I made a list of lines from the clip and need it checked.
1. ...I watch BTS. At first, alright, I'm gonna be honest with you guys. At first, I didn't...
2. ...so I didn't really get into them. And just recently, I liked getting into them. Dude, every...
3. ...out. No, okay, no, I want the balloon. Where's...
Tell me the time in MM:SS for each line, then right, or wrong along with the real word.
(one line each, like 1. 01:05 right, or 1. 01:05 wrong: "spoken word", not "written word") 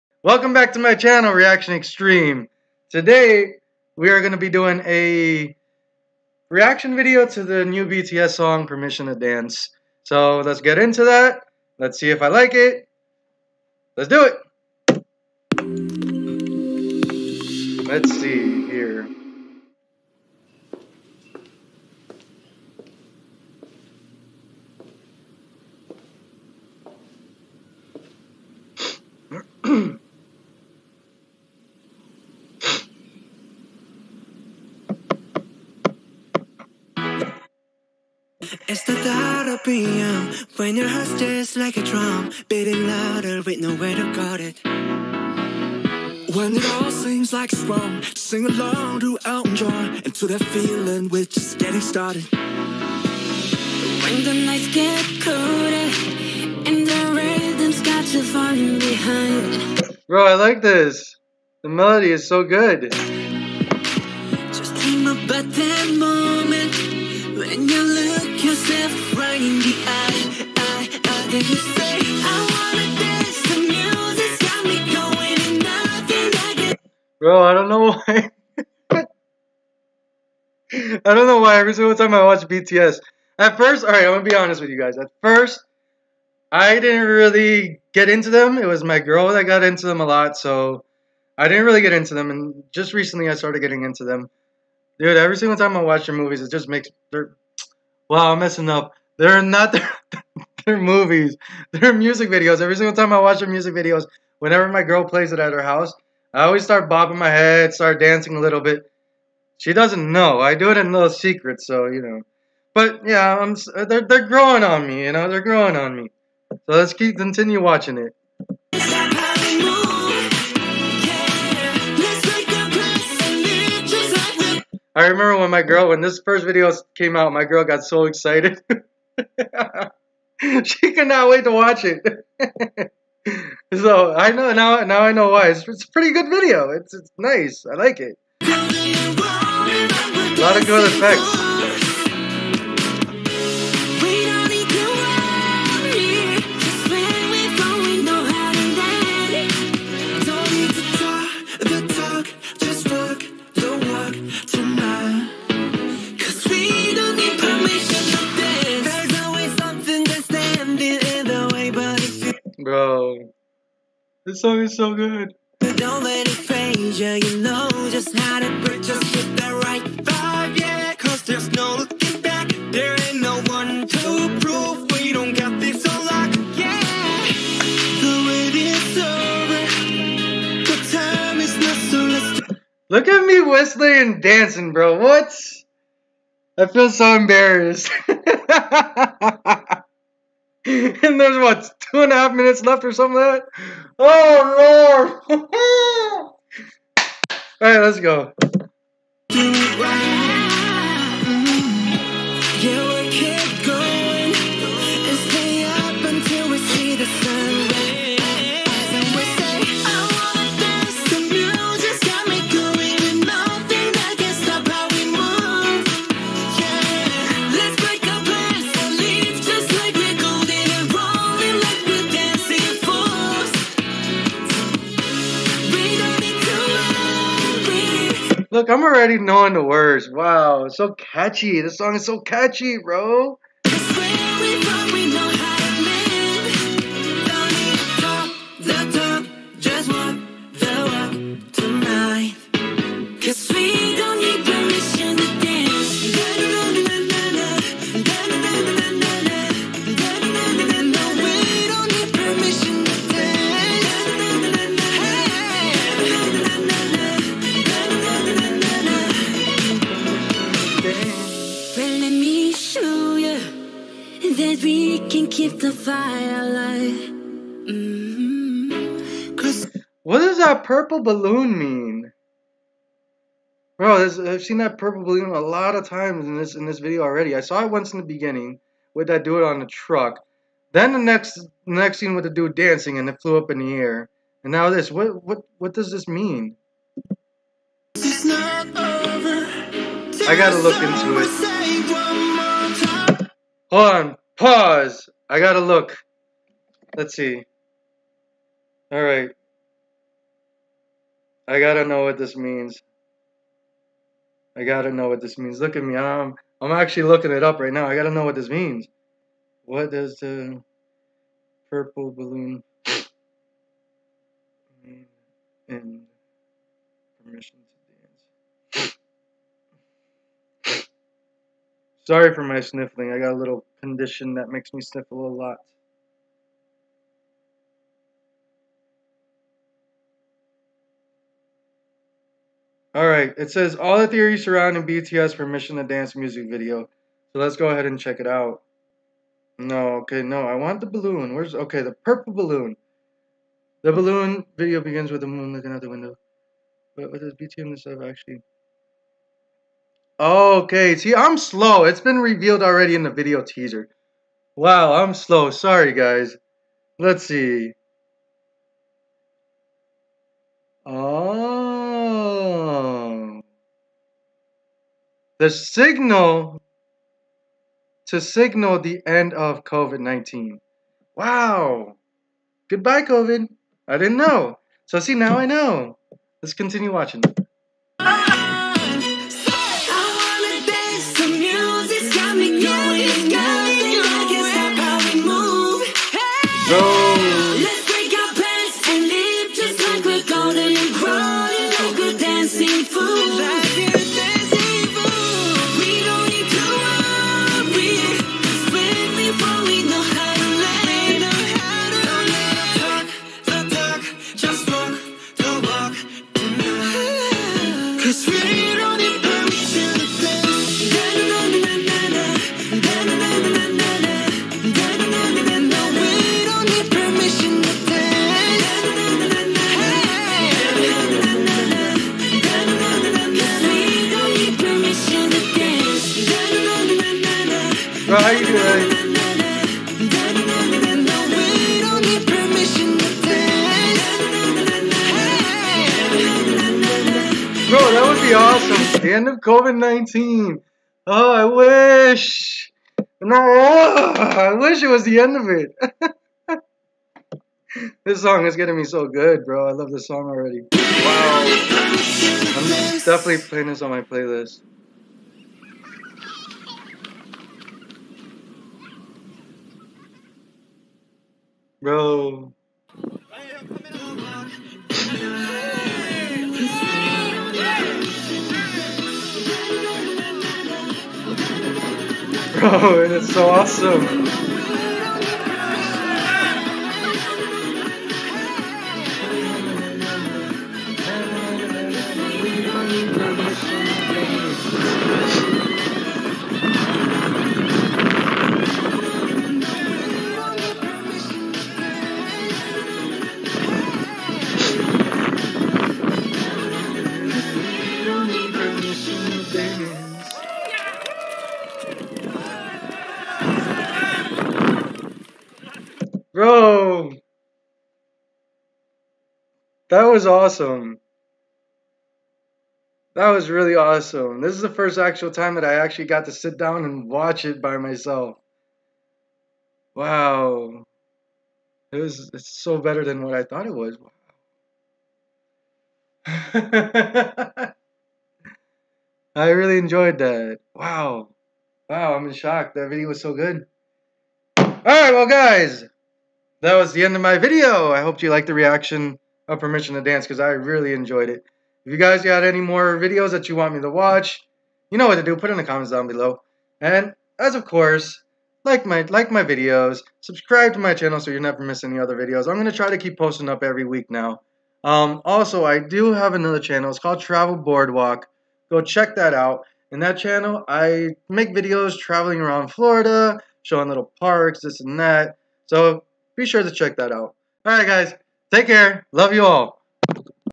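1. 01:22 right
2. 01:30 wrong: "started", not "liked"
3. 05:38 right.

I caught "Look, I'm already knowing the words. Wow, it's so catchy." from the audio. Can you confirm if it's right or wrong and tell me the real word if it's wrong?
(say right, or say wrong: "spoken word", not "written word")
right.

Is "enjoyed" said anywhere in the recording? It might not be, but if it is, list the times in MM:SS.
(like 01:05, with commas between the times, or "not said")
08:49, 09:00.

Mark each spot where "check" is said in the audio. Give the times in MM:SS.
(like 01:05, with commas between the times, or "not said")
05:37, 09:18, 09:26.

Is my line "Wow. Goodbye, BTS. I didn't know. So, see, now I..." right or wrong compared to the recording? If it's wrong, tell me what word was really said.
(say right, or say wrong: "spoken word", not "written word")
wrong: "COVID", not "BTS".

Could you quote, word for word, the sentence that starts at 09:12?
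I'm gonna try to keep posting up every week now.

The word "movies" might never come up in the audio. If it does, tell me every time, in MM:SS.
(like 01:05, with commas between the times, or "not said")
01:36, 01:40.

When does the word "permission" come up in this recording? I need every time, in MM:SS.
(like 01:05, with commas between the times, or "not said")
00:08, 05:17, 05:35, 08:59.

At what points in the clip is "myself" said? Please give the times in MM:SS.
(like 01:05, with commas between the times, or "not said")
08:37.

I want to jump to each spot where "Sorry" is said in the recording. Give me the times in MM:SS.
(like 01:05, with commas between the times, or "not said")
05:22, 05:55.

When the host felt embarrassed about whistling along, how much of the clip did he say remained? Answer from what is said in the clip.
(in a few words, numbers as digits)
Two and a half minutes.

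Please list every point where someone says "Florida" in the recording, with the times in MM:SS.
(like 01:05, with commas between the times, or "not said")
09:22.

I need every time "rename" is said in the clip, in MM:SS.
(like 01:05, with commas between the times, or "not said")
not said.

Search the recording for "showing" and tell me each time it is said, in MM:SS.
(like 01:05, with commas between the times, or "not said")
09:23.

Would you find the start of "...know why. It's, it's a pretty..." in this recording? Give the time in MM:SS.
02:15.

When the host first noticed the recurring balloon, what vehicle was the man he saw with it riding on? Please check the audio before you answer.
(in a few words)
Truck.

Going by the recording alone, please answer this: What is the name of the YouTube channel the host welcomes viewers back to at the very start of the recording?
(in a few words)
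ReactionXtreme.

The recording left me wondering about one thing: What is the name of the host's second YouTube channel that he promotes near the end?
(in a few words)
Travel Boardwalk.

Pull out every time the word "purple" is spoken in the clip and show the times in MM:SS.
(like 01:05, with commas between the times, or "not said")
04:30, 04:34, 05:11, 05:41.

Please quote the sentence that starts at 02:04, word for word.
I remember when my girl, when this first video came out, my girl got so excited.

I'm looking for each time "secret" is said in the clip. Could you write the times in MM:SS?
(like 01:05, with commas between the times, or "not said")
01:51.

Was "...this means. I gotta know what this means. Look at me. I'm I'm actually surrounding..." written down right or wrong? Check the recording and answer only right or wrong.
wrong.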